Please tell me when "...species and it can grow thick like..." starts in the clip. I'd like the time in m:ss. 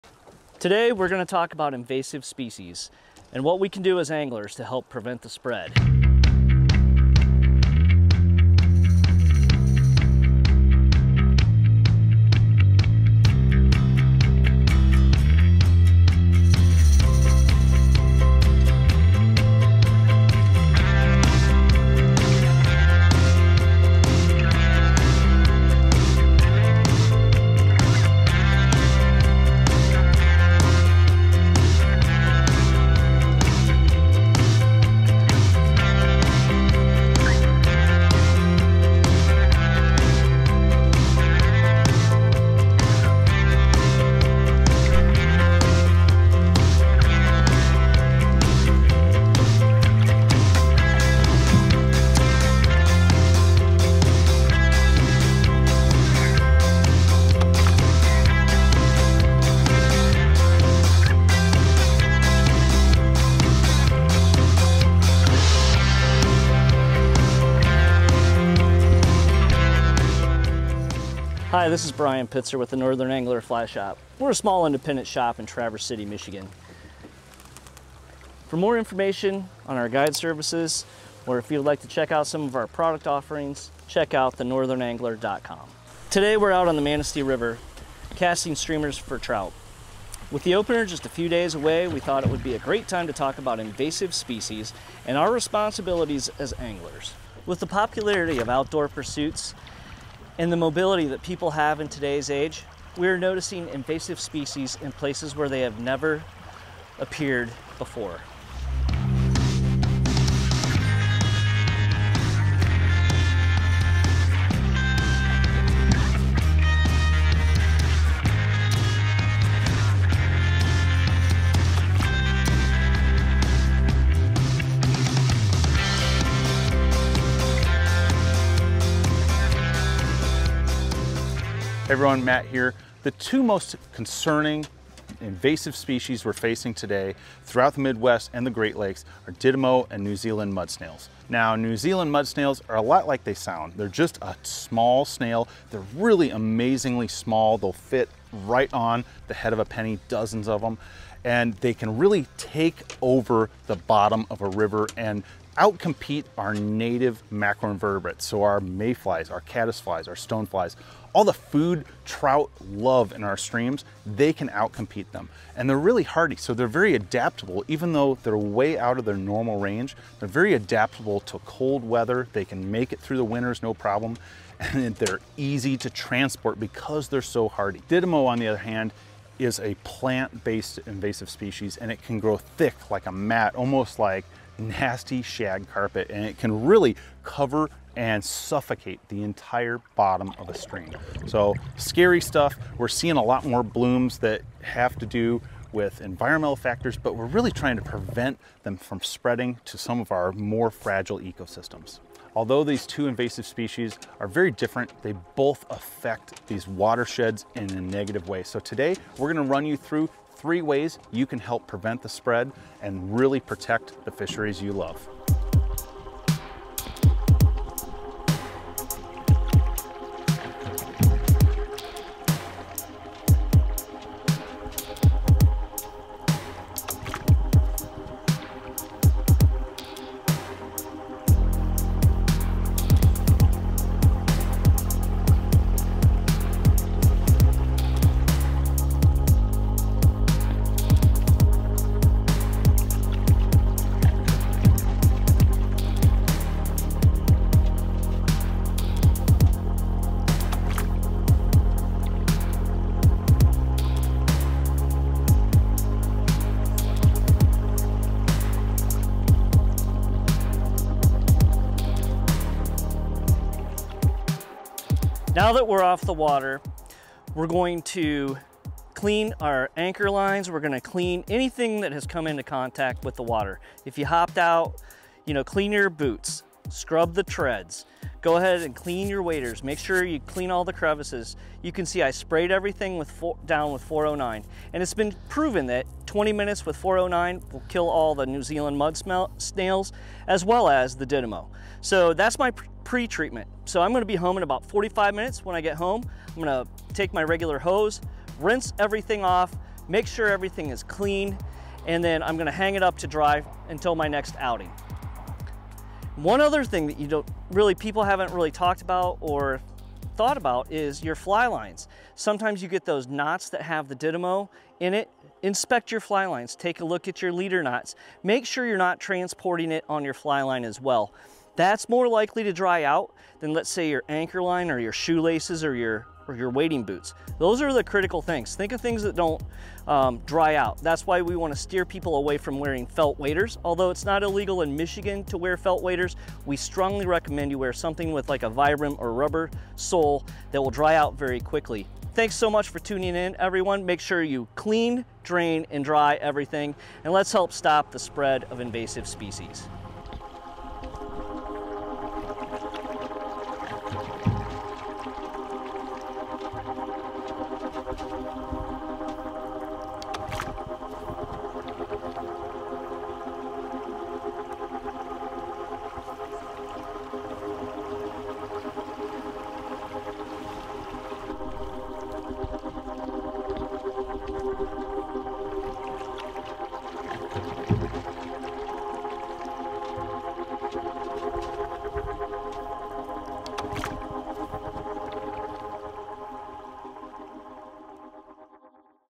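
3:01.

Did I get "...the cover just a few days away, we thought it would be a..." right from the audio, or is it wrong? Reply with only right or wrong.
wrong.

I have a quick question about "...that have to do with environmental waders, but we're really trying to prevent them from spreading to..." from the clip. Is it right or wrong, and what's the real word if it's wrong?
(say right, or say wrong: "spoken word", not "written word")
wrong: "factors", not "waders".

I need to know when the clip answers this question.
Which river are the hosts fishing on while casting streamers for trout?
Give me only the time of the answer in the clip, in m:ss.
1:26.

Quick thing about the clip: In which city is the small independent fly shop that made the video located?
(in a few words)
Traverse City, Michigan.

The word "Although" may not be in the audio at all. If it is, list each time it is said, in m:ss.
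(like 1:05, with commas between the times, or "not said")
3:22, 5:33.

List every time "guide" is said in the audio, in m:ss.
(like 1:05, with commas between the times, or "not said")
1:19.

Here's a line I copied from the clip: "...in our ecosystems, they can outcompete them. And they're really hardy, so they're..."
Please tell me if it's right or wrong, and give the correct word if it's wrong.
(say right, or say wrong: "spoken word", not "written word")
wrong: "streams", not "ecosystems".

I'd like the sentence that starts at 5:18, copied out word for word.
Make sure you're not transporting it on your fly line as well.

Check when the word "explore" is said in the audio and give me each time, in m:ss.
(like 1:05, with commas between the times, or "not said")
not said.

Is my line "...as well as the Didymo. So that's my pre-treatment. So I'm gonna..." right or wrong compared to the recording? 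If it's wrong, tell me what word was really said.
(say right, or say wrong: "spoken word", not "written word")
right.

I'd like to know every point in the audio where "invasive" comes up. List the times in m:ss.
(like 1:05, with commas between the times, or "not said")
0:01, 1:33, 1:43, 2:15, 3:00, 3:23, 5:48.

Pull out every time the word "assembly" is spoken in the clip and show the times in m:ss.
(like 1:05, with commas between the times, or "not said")
not said.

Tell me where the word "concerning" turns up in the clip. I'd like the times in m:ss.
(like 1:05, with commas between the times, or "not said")
2:13.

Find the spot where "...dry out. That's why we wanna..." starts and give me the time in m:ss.
5:30.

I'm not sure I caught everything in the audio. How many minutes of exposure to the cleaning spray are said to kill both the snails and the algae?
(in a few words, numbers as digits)
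20.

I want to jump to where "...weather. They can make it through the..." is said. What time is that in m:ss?
2:51.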